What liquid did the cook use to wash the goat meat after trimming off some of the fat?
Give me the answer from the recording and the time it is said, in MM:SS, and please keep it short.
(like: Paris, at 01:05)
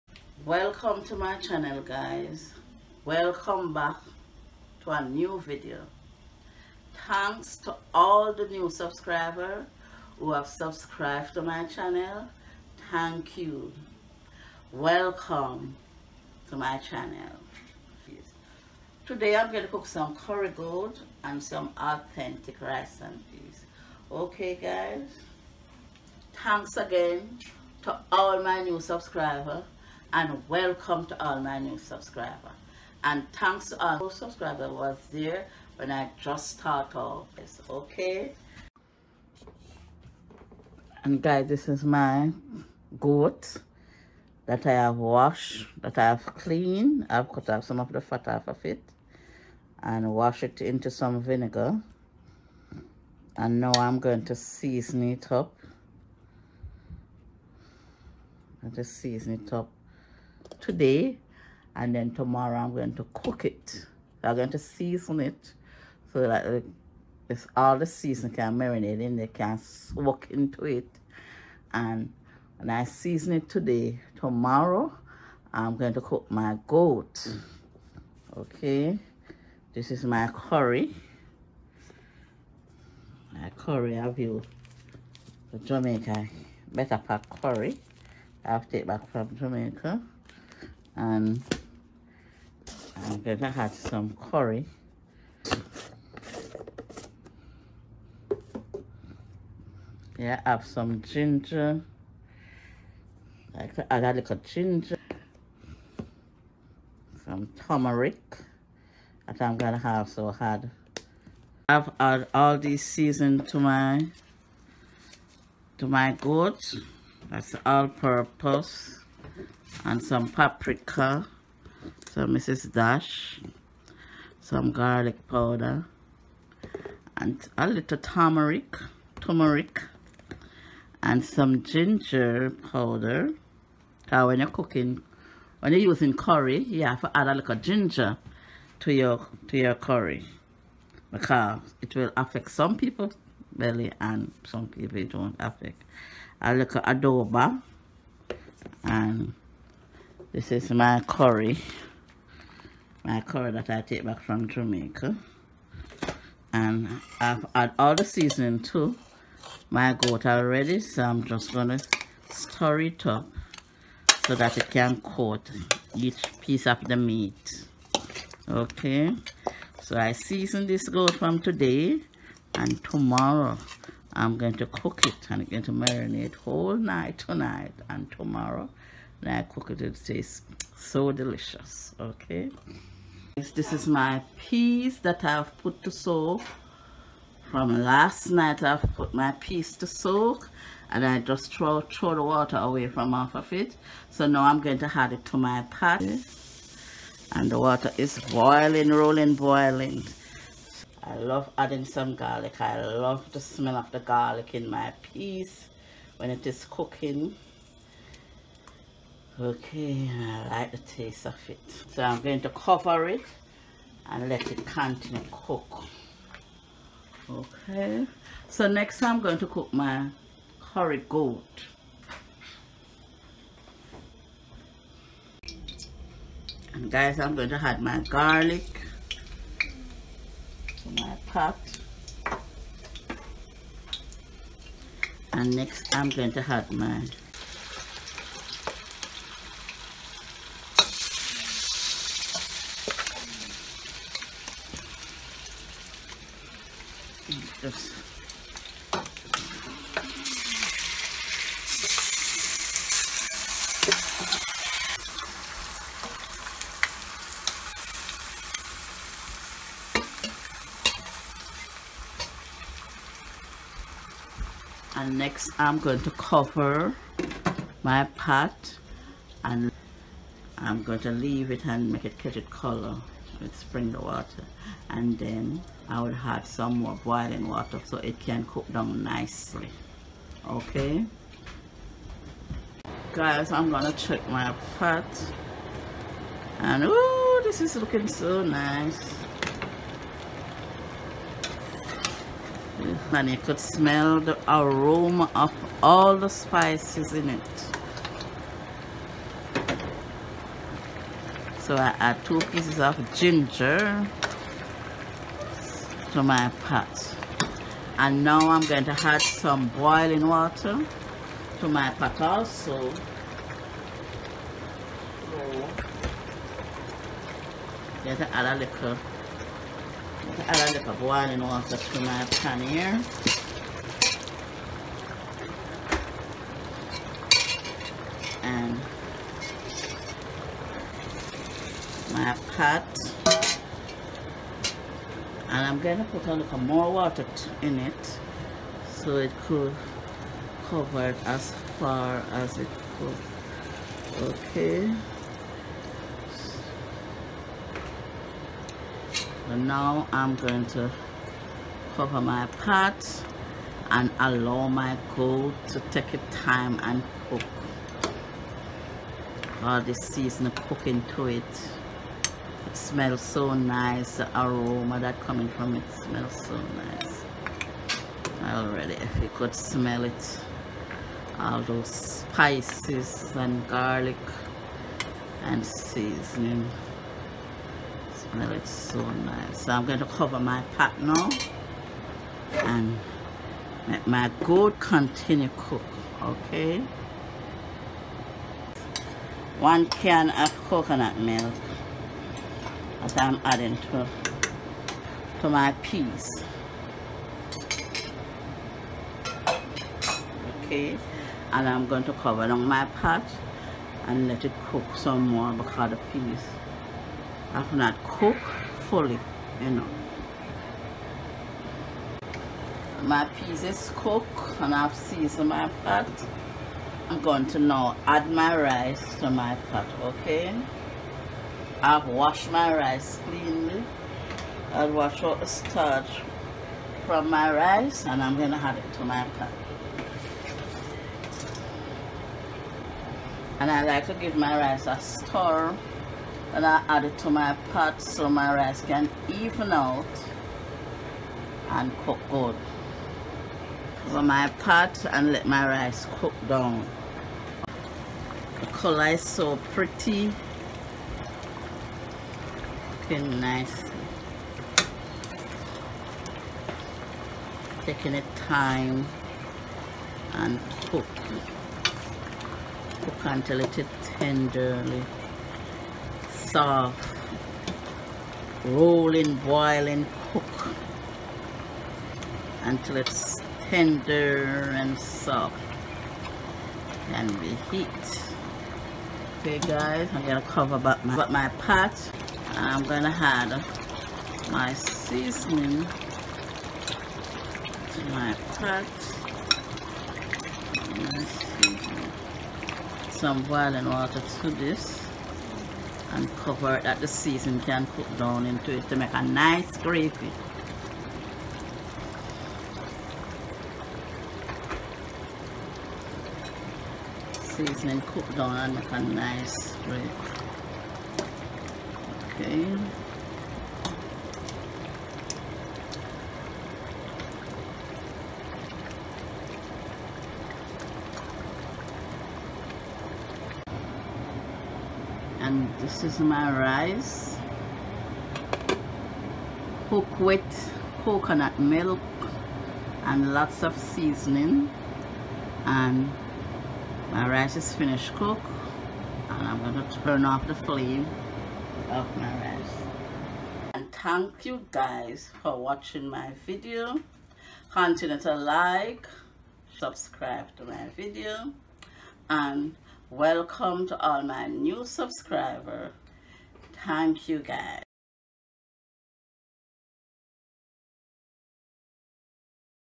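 Vinegar, at 00:51.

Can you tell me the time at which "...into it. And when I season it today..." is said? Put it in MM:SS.
01:10.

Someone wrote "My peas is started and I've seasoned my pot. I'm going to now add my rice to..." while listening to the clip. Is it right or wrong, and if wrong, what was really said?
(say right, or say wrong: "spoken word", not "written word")
wrong: "cooked", not "started".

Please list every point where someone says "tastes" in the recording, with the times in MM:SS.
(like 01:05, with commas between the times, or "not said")
03:00, 03:30.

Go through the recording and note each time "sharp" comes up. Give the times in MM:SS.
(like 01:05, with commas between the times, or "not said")
not said.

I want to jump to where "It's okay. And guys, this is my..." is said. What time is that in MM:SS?
00:37.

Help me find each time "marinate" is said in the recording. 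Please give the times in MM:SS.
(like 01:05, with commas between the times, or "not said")
01:08, 02:55.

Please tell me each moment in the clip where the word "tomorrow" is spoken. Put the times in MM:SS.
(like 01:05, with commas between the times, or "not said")
01:02, 01:14, 02:52, 02:58.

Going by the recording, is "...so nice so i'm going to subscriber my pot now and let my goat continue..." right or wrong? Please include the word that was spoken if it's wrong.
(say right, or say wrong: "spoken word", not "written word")
wrong: "cover", not "subscriber".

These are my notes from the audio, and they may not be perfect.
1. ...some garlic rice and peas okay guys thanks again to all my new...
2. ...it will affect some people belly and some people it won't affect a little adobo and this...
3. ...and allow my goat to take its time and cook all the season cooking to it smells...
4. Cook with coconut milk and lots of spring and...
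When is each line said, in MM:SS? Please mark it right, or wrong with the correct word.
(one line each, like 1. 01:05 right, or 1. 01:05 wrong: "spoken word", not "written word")
1. 00:21 wrong: "authentic", not "garlic"
2. 02:21 right
3. 05:53 right
4. 08:49 wrong: "seasoning", not "spring".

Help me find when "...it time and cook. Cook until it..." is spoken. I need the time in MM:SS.
07:38.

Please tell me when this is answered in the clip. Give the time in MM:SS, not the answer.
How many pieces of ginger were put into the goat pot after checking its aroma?
05:02.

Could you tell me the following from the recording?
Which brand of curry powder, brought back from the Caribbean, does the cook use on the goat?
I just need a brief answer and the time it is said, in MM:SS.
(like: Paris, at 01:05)
Betapac, at 01:26.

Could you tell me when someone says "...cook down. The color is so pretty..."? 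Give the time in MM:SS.
07:26.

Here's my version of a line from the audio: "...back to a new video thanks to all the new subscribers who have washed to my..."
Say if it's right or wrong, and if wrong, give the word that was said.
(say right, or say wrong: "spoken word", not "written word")
wrong: "subscribed", not "washed".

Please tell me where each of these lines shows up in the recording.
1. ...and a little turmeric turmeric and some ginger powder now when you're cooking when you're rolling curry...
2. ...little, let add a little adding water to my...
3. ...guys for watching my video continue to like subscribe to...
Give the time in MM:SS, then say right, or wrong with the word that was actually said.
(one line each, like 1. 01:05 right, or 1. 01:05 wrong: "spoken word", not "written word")
1. 02:07 wrong: "using", not "rolling"
2. 05:18 wrong: "boiling", not "adding"
3. 09:04 right.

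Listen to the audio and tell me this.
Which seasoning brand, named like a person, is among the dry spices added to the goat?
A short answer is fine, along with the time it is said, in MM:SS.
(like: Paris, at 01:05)
Mrs. Dash, at 02:02.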